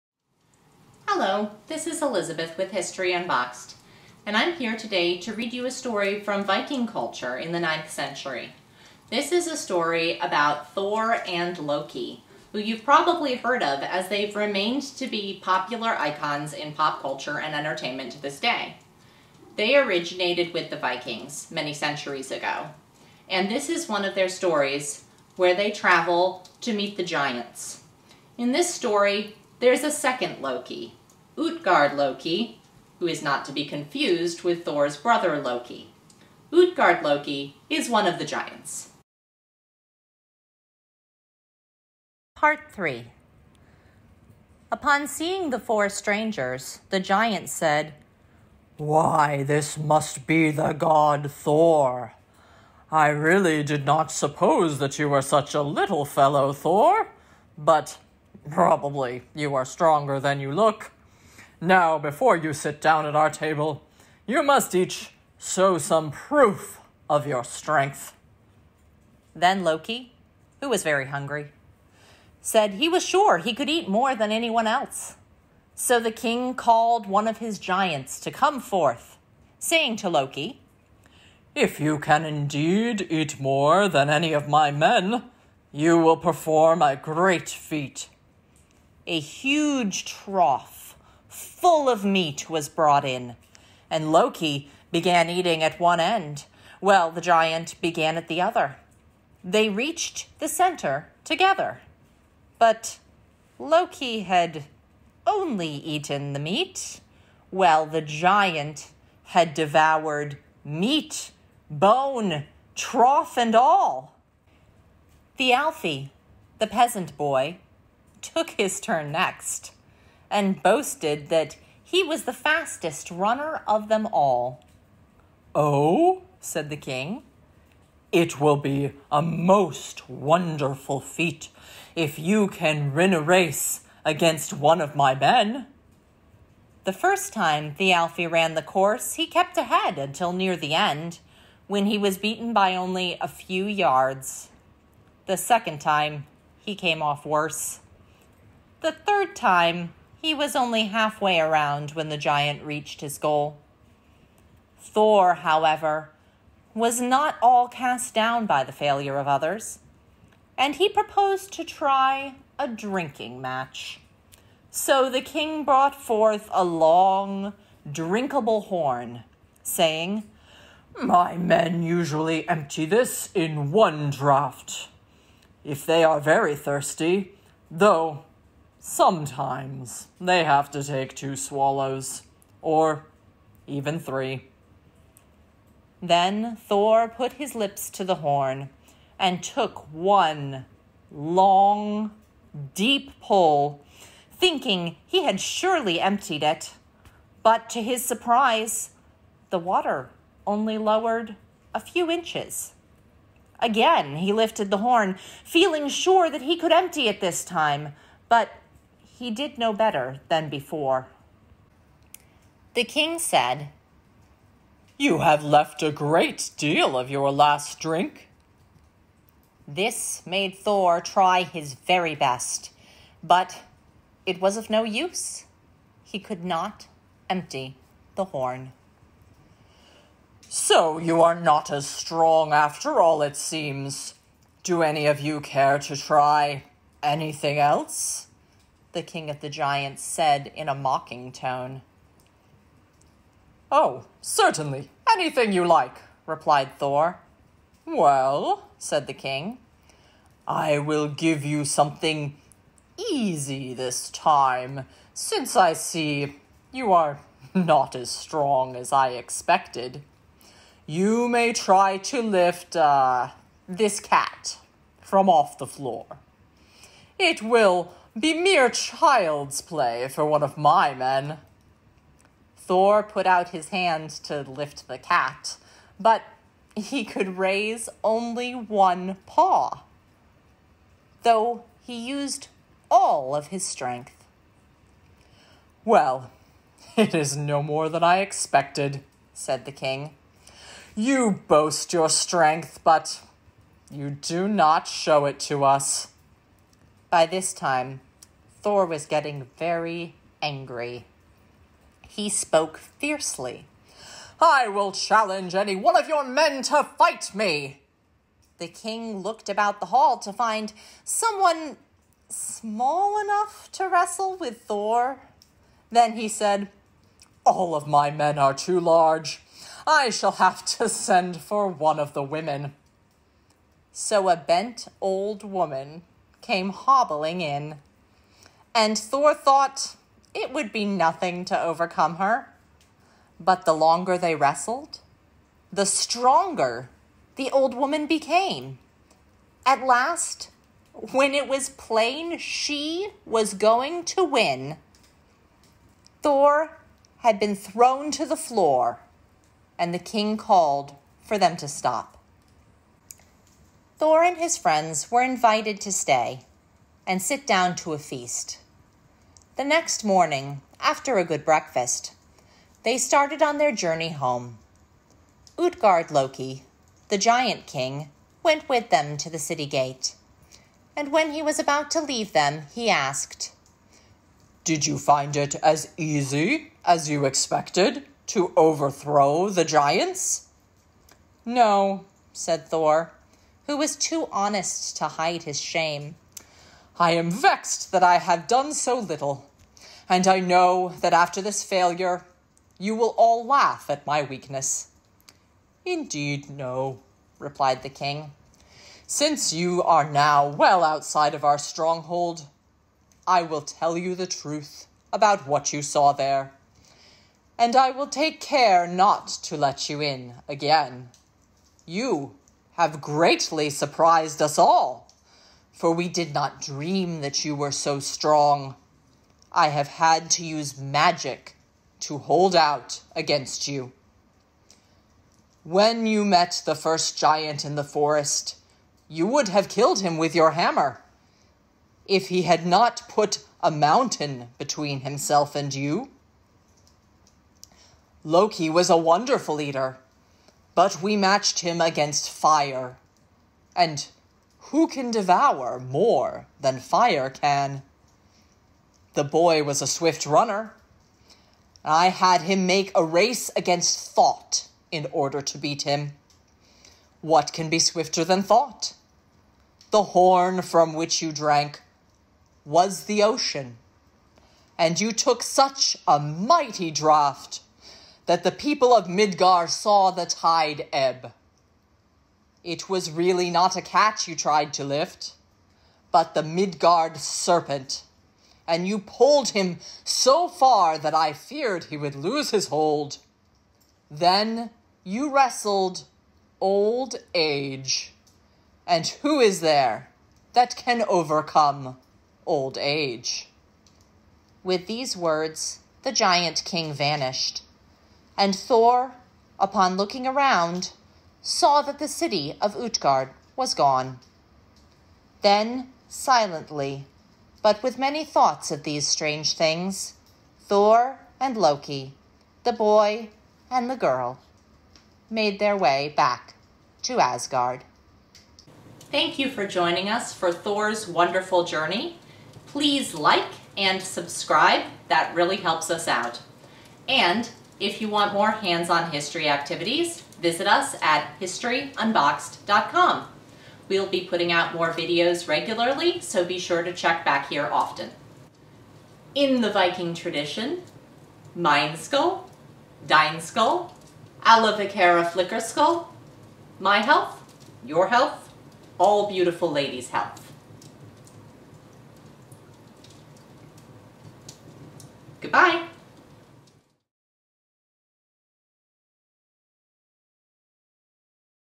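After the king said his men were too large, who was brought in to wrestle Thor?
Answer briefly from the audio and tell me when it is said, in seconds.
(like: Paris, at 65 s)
bent old woman, at 324 s.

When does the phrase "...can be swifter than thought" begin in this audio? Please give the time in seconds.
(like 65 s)
457 s.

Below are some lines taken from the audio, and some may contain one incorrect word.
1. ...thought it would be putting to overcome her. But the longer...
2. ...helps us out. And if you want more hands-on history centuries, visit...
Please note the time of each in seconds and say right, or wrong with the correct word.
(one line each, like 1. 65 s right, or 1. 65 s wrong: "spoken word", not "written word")
1. 329 s wrong: "nothing", not "putting"
2. 525 s wrong: "activities", not "centuries".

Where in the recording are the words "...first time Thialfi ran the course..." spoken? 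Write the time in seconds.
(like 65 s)
136 s.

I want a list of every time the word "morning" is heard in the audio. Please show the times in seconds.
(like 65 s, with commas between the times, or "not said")
360 s.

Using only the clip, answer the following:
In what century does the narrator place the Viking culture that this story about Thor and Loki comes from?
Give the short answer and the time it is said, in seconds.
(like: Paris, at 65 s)
9th century, at 7 s.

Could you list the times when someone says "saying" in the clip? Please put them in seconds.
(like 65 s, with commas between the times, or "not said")
79 s, 169 s.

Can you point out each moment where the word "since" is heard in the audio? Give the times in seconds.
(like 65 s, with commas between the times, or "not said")
255 s, 399 s.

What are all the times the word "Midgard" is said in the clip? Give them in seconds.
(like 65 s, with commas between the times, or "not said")
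469 s, 476 s.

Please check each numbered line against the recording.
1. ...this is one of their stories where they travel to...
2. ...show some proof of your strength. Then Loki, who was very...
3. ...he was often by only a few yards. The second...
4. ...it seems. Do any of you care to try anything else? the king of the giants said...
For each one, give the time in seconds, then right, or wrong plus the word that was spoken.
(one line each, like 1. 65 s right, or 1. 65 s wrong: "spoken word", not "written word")
1. 23 s right
2. 65 s right
3. 141 s wrong: "beaten", not "often"
4. 233 s right.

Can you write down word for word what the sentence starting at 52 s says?
I really did not suppose that you were such a little fellow, Thor, but probably you are stronger than you look.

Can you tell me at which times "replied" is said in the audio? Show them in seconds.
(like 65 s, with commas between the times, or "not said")
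246 s, 397 s.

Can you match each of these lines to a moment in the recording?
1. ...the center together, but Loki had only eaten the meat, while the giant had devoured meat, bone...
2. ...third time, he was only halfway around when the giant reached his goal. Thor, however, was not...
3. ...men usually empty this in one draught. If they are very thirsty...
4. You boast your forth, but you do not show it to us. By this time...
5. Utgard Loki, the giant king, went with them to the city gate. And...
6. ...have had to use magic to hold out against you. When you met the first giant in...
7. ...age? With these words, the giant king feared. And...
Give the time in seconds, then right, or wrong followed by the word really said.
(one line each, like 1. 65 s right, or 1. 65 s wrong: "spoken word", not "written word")
1. 100 s right
2. 148 s right
3. 171 s right
4. 290 s wrong: "strength", not "forth"
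5. 365 s right
6. 419 s right
7. 492 s wrong: "vanished", not "feared".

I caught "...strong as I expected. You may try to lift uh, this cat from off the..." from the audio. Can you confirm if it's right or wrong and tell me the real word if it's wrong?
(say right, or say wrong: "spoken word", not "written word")
right.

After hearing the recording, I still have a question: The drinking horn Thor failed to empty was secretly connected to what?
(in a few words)
the ocean.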